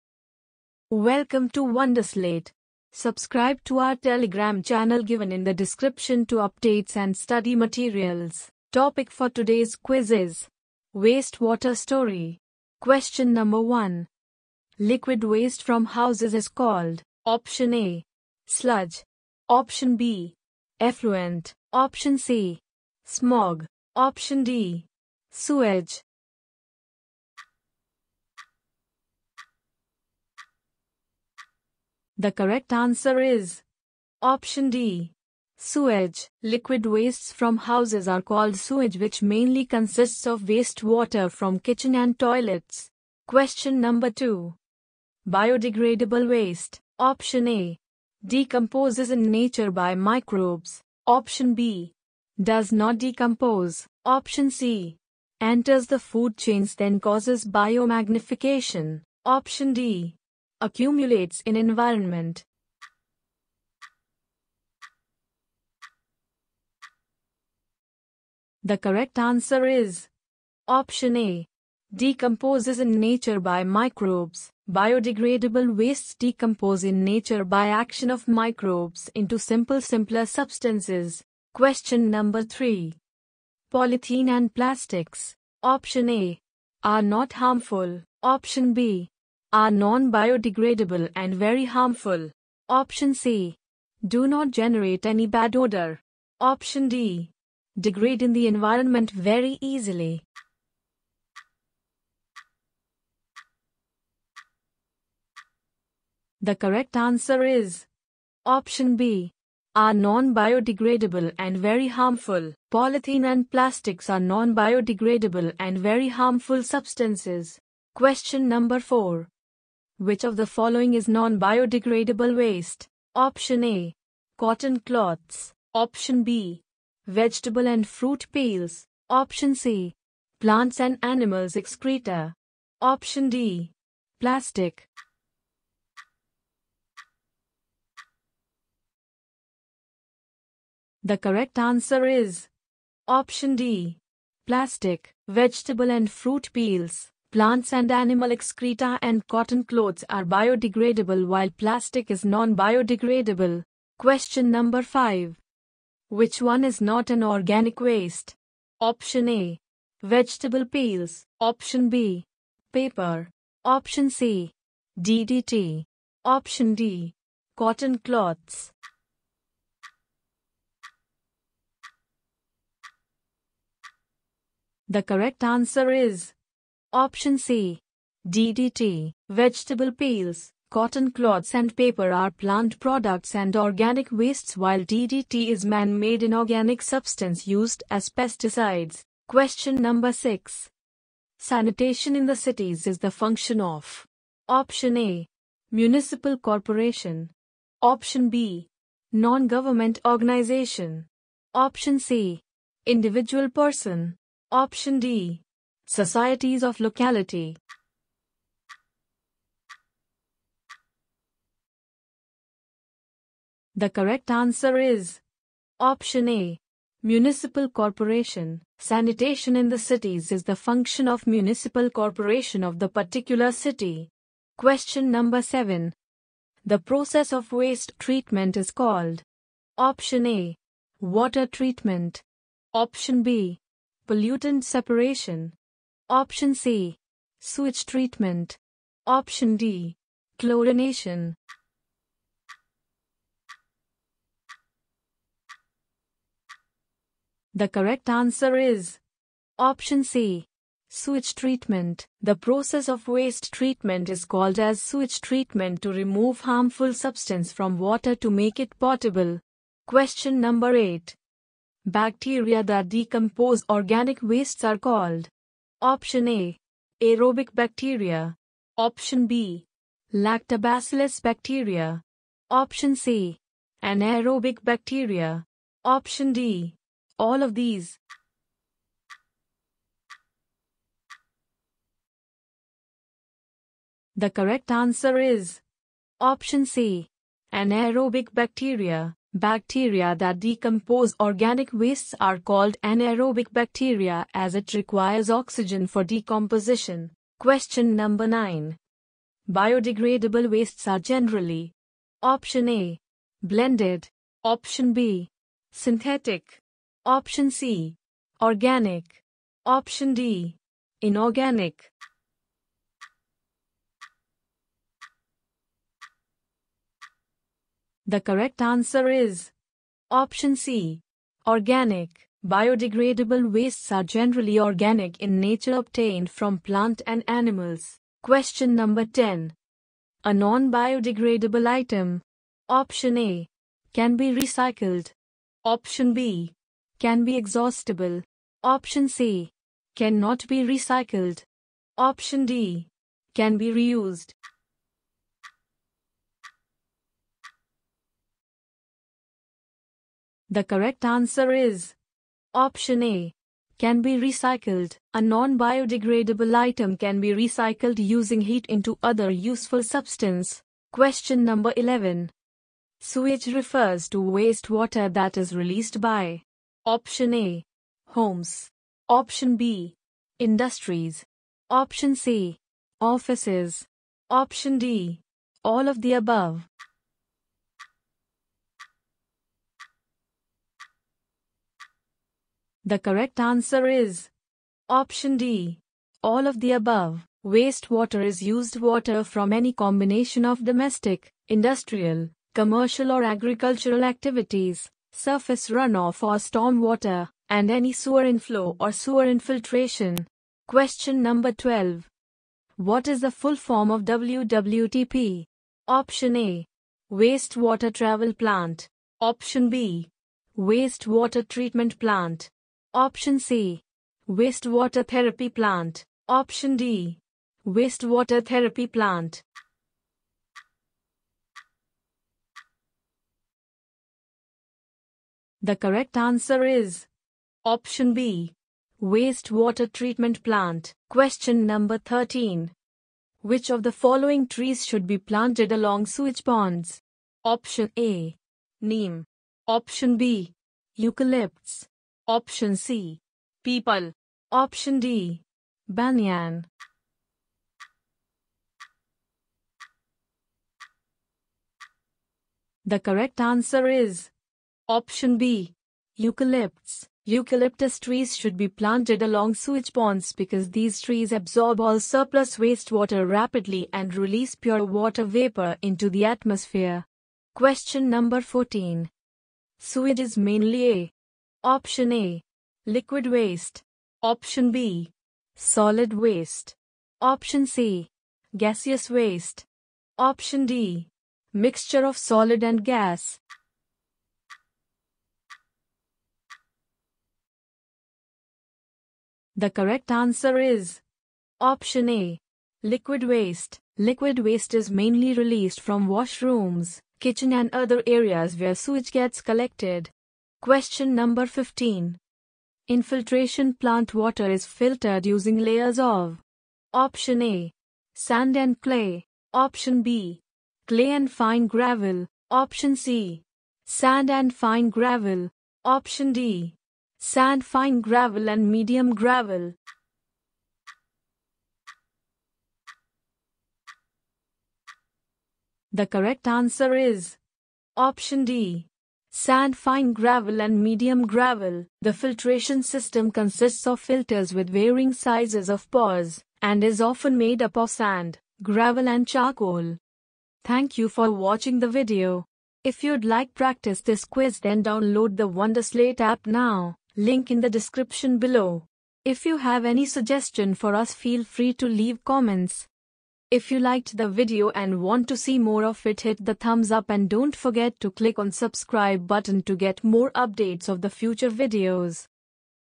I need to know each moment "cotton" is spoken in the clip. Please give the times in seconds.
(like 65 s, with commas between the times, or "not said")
124 s, 149 s, 167 s, 180 s.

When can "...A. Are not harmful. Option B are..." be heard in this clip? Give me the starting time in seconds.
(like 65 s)
86 s.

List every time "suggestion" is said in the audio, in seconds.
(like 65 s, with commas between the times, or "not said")
550 s.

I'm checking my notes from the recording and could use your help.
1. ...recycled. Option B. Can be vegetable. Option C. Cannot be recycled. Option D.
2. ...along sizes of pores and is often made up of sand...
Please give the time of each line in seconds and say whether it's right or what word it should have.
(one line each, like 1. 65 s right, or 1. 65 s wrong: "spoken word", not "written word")
1. 334 s wrong: "exhaustible", not "vegetable"
2. 534 s wrong: "varying", not "along".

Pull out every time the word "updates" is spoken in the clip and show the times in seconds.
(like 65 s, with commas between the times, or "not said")
6 s, 560 s.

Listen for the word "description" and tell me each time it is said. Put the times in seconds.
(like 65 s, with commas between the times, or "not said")
5 s, 547 s.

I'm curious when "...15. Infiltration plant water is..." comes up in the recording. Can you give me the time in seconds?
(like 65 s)
501 s.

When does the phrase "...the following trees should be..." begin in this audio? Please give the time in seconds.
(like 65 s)
433 s.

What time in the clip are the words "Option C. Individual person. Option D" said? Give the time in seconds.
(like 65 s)
201 s.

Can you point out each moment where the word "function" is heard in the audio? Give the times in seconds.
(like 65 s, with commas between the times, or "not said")
193 s, 220 s.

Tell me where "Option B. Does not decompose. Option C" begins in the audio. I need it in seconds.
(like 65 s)
51 s.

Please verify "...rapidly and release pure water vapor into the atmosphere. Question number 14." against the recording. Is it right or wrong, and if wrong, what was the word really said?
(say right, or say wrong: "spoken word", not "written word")
right.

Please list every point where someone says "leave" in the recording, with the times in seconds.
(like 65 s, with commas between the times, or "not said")
551 s.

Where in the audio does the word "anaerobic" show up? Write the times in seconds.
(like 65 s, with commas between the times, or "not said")
273 s, 287 s, 292 s.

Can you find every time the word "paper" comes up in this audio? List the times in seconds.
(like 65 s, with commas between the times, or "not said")
162 s, 181 s.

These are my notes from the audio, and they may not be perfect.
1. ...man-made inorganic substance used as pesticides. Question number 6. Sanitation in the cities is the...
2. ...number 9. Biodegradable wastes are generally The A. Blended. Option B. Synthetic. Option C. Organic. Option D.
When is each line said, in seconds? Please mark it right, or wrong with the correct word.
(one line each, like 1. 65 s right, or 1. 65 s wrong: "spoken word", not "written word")
1. 185 s right
2. 297 s wrong: "Option", not "The".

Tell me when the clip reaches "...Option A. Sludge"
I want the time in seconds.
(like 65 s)
17 s.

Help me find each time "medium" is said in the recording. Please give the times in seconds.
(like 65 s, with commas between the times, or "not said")
518 s, 530 s.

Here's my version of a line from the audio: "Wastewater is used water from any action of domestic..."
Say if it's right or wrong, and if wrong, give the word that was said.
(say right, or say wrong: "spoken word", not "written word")
wrong: "combination", not "action".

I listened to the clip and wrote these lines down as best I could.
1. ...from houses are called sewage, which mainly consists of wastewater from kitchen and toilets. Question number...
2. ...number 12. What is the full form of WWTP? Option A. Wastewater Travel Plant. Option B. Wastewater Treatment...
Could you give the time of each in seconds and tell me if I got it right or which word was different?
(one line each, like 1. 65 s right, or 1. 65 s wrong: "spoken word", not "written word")
1. 37 s right
2. 401 s right.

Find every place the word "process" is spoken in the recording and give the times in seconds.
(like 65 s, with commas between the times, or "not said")
226 s, 252 s.